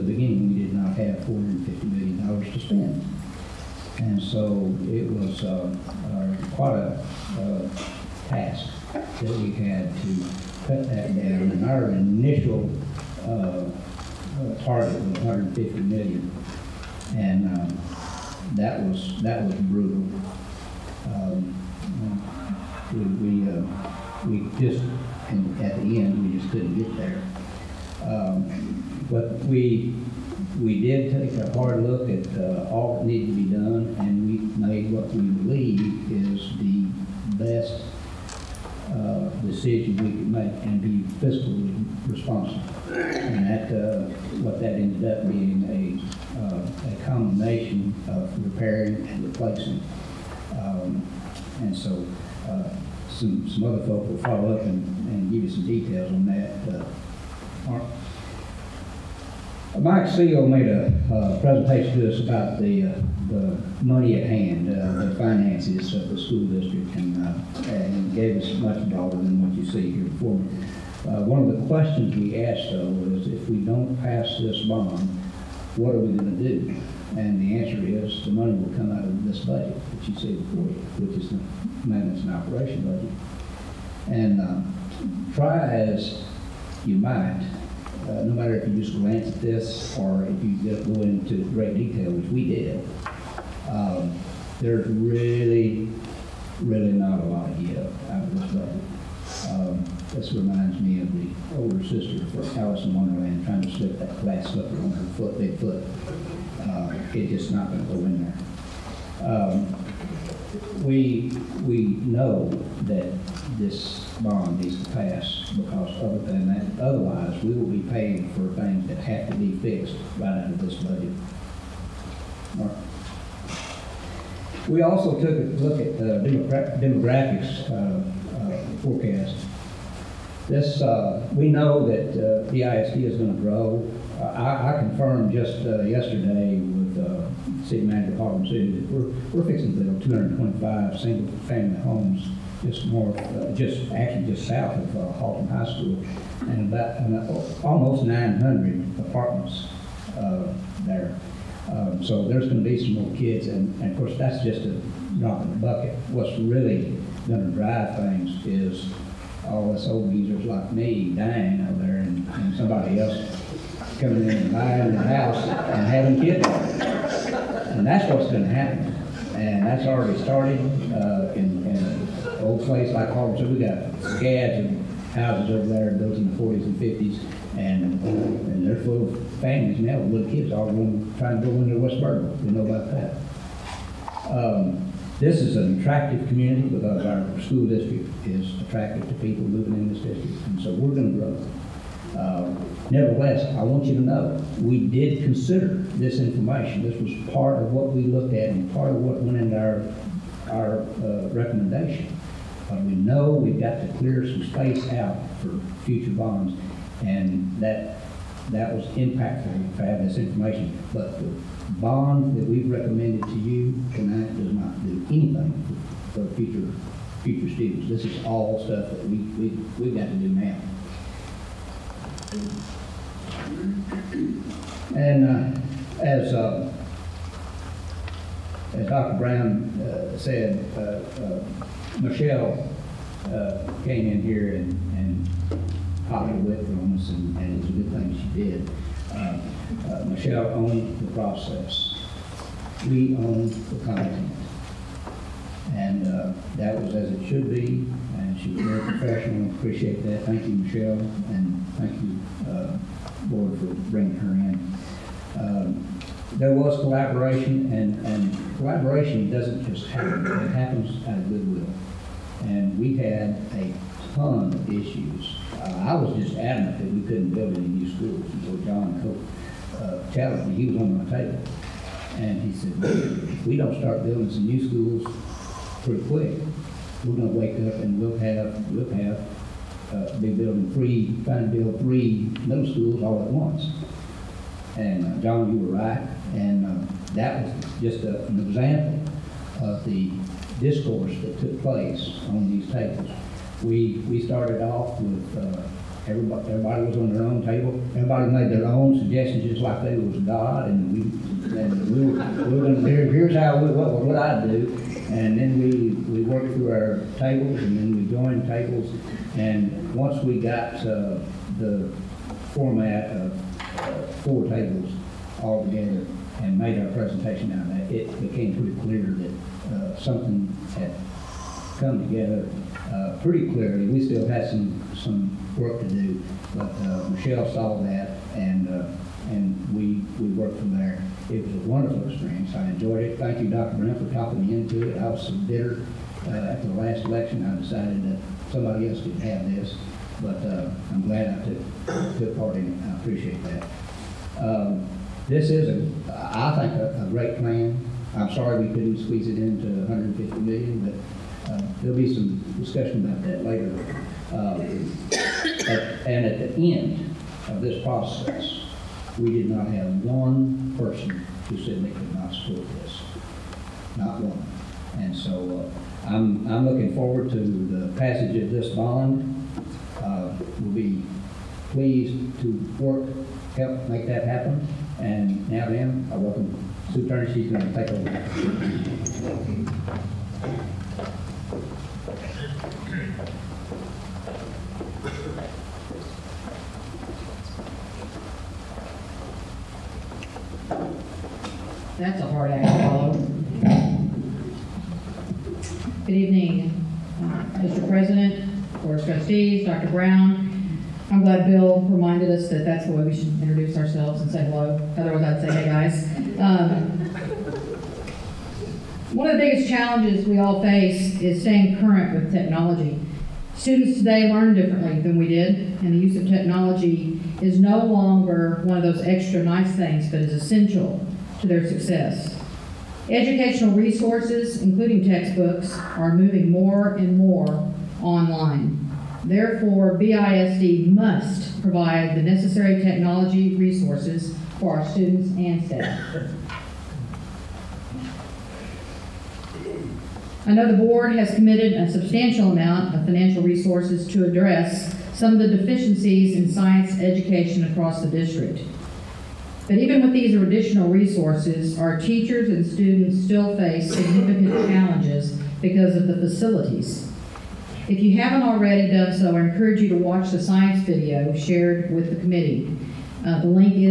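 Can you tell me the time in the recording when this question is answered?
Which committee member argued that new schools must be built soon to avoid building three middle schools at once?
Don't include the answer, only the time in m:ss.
4:28.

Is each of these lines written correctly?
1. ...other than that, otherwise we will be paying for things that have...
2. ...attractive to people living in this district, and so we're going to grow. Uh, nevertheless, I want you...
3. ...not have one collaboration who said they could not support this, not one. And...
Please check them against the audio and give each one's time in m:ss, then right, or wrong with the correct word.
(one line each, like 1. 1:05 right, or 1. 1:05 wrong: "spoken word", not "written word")
1. 1:56 right
2. 3:08 right
3. 5:59 wrong: "person", not "collaboration".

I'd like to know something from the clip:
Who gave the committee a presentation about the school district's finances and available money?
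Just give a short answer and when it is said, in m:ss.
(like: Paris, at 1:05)
Mike Seal, at 0:59.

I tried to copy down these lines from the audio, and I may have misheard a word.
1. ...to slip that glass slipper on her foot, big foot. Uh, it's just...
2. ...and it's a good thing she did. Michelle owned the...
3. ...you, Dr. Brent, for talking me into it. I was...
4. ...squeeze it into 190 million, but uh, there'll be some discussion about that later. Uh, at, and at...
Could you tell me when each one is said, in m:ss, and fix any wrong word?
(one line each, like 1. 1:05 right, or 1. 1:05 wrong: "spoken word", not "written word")
1. 1:43 right
2. 3:57 right
3. 5:33 right
4. 5:49 wrong: "150", not "190".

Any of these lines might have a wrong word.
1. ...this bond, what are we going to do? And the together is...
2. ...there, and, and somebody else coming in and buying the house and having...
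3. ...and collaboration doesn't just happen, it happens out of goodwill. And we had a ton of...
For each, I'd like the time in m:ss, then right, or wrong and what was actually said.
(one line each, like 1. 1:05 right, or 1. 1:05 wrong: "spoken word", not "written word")
1. 1:14 wrong: "answer", not "together"
2. 2:41 right
3. 4:18 right.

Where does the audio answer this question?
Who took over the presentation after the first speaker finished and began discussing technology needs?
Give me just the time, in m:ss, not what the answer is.
6:16.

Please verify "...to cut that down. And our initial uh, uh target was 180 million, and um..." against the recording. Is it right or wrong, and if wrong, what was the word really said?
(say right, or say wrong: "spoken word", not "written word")
wrong: "150", not "180".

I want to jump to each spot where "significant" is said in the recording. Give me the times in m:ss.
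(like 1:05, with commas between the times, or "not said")
7:33.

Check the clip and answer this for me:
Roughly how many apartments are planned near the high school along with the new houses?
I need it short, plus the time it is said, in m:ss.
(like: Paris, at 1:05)
900, at 2:28.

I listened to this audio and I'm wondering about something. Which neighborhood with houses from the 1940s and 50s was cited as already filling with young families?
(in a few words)
Harvard.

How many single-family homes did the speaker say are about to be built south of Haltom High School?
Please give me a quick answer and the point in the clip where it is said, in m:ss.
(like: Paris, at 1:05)
225, at 2:20.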